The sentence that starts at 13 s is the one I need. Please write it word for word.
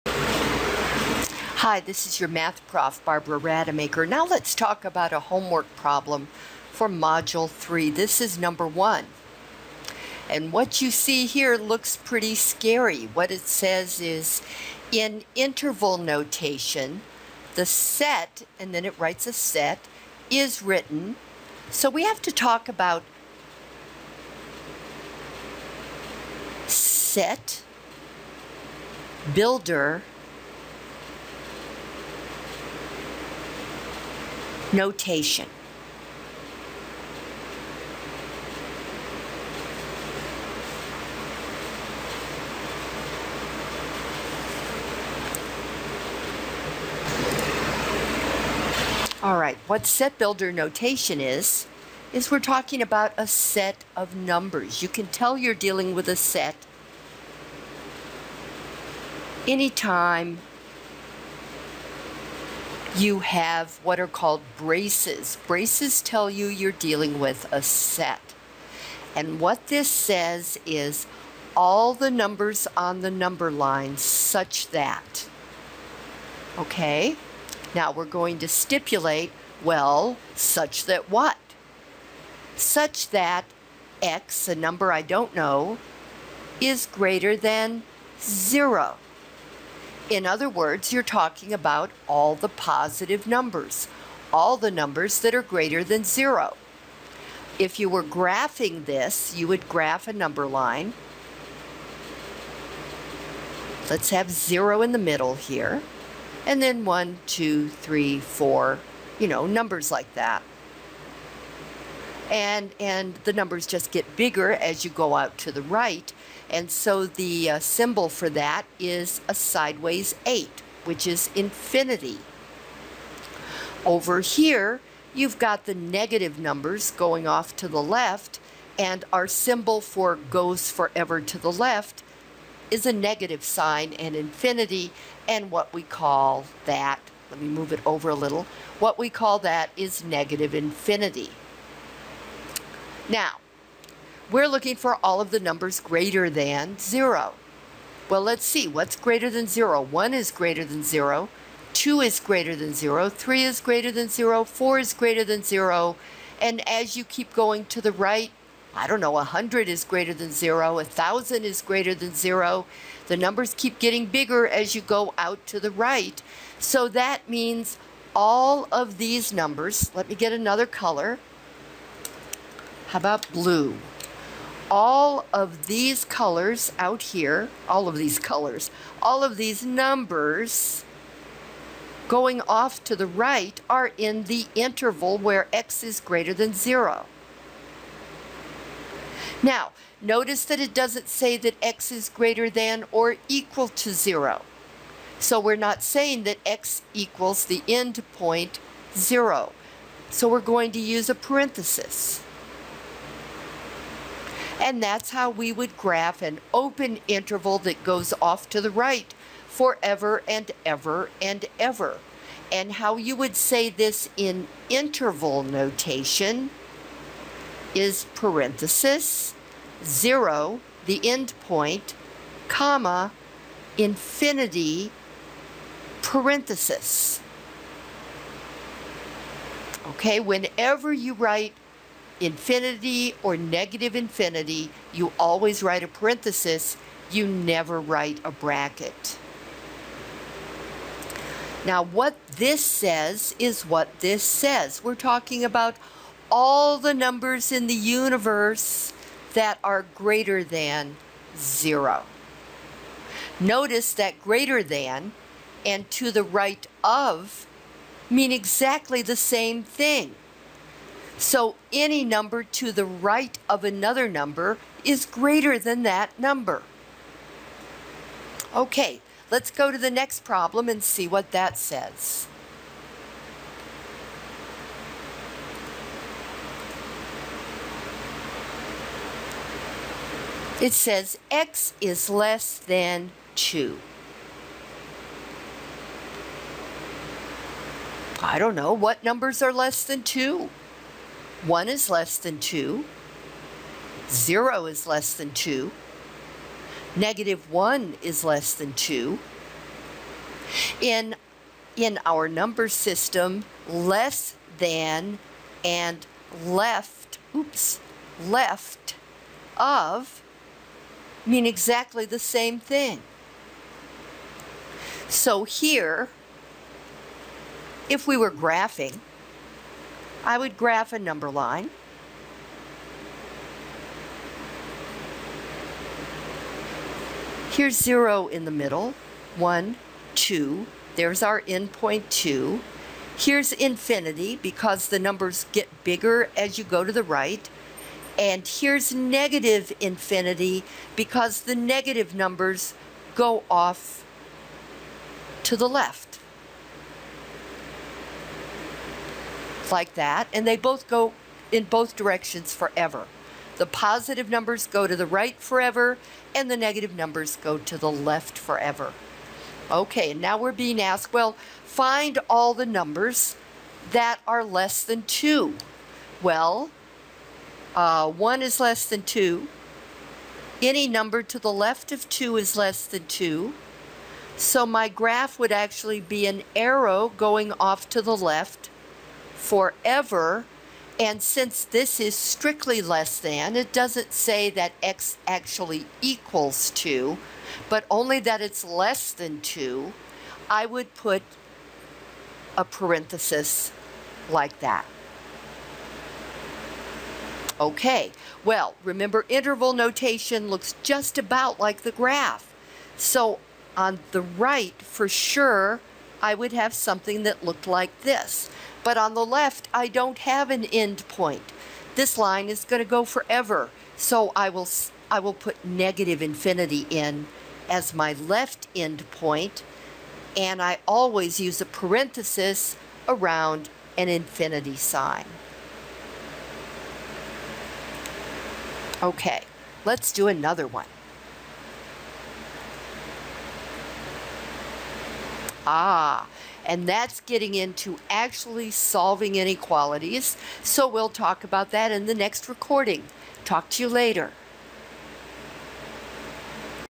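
What it says is, in interval notation, the set, and then it writes a set, is written.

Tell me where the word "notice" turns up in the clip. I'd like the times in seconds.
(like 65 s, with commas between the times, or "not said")
190 s, 253 s.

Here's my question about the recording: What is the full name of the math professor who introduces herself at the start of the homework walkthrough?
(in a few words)
Barbara Rademacher.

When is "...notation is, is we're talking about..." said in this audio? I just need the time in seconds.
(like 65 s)
50 s.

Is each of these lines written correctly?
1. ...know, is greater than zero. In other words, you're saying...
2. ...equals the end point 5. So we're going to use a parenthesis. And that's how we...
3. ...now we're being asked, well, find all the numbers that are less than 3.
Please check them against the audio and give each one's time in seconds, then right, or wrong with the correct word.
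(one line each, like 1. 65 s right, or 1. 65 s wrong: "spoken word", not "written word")
1. 85 s wrong: "talking", not "saying"
2. 196 s wrong: "0", not "5"
3. 360 s wrong: "2", not "3".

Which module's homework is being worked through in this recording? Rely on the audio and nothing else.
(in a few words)
Module 3.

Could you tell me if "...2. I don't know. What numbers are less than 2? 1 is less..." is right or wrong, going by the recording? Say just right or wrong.
right.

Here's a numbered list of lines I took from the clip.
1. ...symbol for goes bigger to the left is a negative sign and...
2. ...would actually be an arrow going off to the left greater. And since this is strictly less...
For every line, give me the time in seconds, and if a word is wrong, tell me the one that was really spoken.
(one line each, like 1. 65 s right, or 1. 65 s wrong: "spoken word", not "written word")
1. 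129 s wrong: "forever", not "bigger"
2. 375 s wrong: "forever", not "greater".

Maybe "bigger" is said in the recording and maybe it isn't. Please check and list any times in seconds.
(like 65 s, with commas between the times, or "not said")
114 s, 164 s, 335 s.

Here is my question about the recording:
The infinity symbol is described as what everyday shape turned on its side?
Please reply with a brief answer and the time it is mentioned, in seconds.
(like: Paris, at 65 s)
an 8, at 119 s.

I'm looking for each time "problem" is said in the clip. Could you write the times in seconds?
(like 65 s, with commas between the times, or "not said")
5 s, 270 s.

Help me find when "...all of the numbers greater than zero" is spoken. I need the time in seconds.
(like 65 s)
145 s.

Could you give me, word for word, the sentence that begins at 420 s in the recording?
And I always use a parenthesis around an infinity sign.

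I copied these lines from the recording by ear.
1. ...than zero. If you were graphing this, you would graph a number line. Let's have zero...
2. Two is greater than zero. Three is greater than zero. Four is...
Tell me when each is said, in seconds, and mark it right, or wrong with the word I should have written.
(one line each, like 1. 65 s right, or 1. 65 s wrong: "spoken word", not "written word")
1. 95 s right
2. 151 s right.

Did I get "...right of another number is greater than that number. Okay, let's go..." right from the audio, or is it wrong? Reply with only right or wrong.
right.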